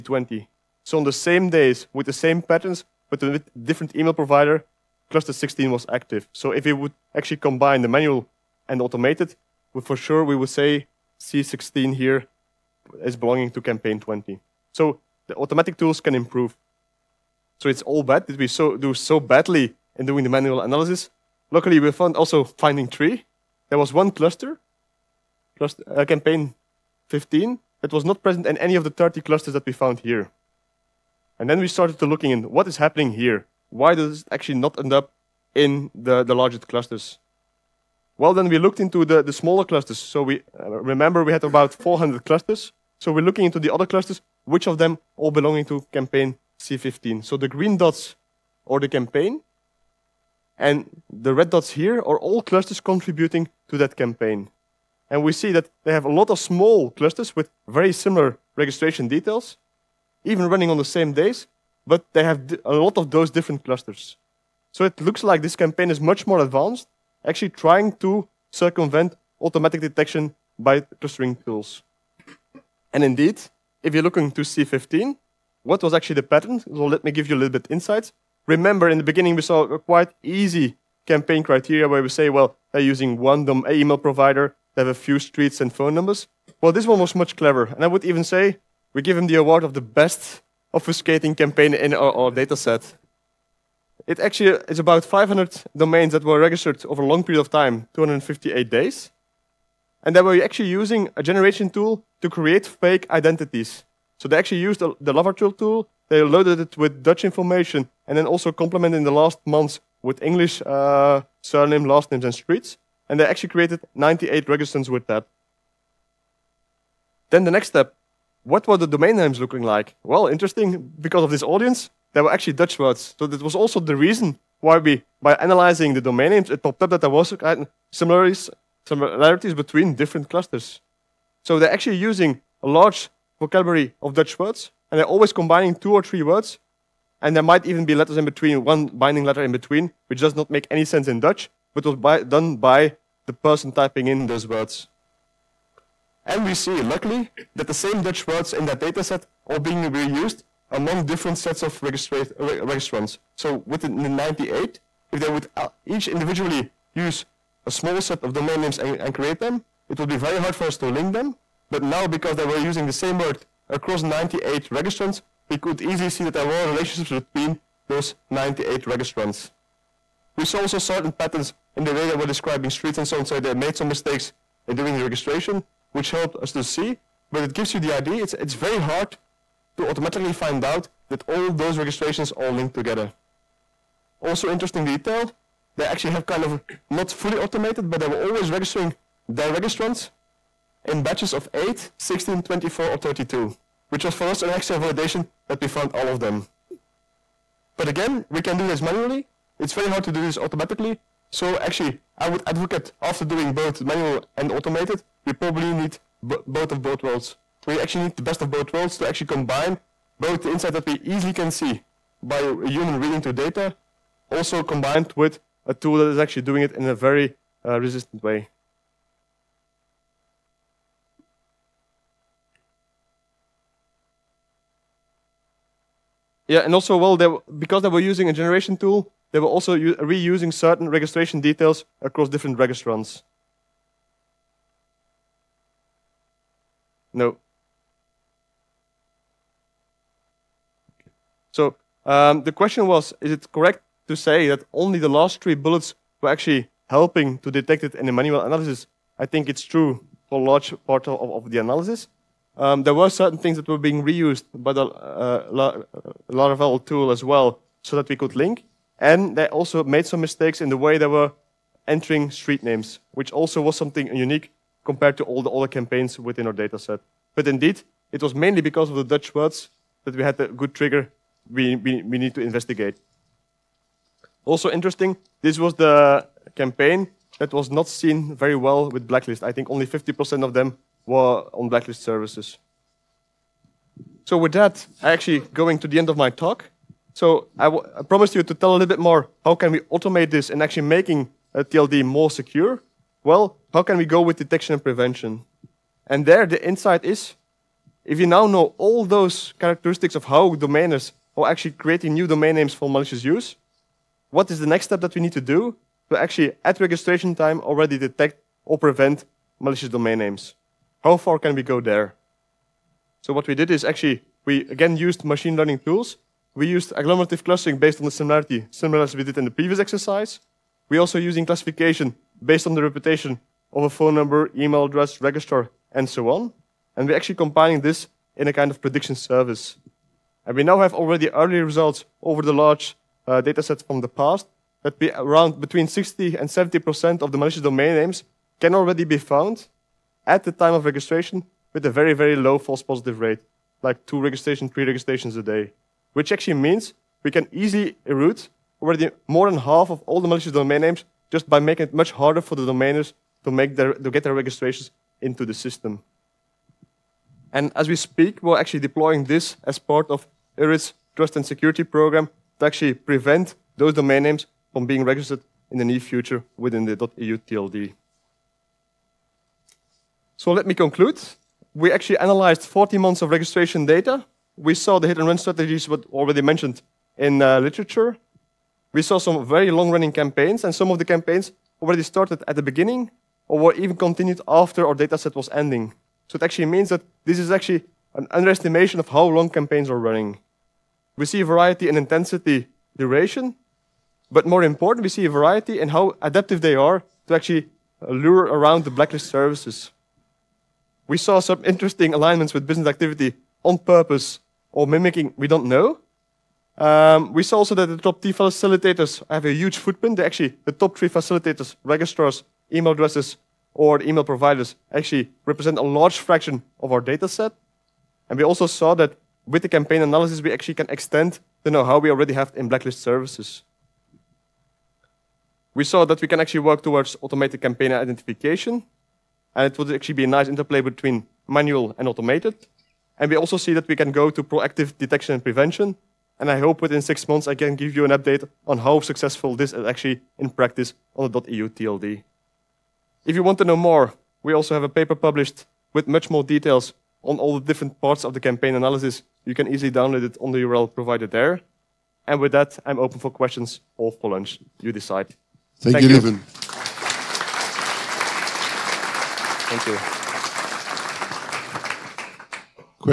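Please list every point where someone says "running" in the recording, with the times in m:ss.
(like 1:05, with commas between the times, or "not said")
1:00, 6:19, 6:29.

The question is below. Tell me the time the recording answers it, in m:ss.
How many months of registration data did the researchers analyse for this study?
6:12.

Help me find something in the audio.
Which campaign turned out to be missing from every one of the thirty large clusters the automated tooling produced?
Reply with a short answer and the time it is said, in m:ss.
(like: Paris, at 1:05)
Campaign 15, at 0:26.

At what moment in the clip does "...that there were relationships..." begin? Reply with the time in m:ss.
2:46.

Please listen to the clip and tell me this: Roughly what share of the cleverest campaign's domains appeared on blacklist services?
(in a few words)
50%.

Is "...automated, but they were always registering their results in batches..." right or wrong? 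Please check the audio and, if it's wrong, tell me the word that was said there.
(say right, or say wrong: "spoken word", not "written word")
wrong: "registrants", not "results".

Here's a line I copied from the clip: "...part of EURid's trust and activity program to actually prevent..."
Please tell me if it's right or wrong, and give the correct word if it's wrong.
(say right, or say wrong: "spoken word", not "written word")
wrong: "security", not "activity".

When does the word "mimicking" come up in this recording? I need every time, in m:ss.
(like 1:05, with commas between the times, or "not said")
6:44.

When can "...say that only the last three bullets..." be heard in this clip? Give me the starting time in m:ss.
4:04.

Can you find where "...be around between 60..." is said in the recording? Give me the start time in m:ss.
5:34.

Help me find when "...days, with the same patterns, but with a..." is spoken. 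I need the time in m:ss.
0:01.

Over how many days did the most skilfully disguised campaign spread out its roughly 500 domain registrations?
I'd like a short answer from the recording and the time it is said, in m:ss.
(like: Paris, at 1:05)
258, at 1:37.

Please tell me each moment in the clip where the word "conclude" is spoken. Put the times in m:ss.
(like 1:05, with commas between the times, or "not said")
6:10.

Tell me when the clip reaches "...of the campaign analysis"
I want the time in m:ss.
7:28.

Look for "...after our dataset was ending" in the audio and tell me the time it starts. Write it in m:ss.
6:24.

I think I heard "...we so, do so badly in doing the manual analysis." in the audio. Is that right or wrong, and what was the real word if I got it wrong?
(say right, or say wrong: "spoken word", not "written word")
right.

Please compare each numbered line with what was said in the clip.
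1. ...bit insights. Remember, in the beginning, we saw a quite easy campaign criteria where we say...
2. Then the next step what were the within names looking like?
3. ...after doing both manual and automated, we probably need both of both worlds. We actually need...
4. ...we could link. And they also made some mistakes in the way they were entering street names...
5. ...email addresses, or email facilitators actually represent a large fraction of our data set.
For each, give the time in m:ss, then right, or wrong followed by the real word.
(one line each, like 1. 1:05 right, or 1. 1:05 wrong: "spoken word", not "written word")
1. 1:17 right
2. 1:57 wrong: "domain", not "within"
3. 3:23 right
4. 4:18 right
5. 6:52 wrong: "providers", not "facilitators".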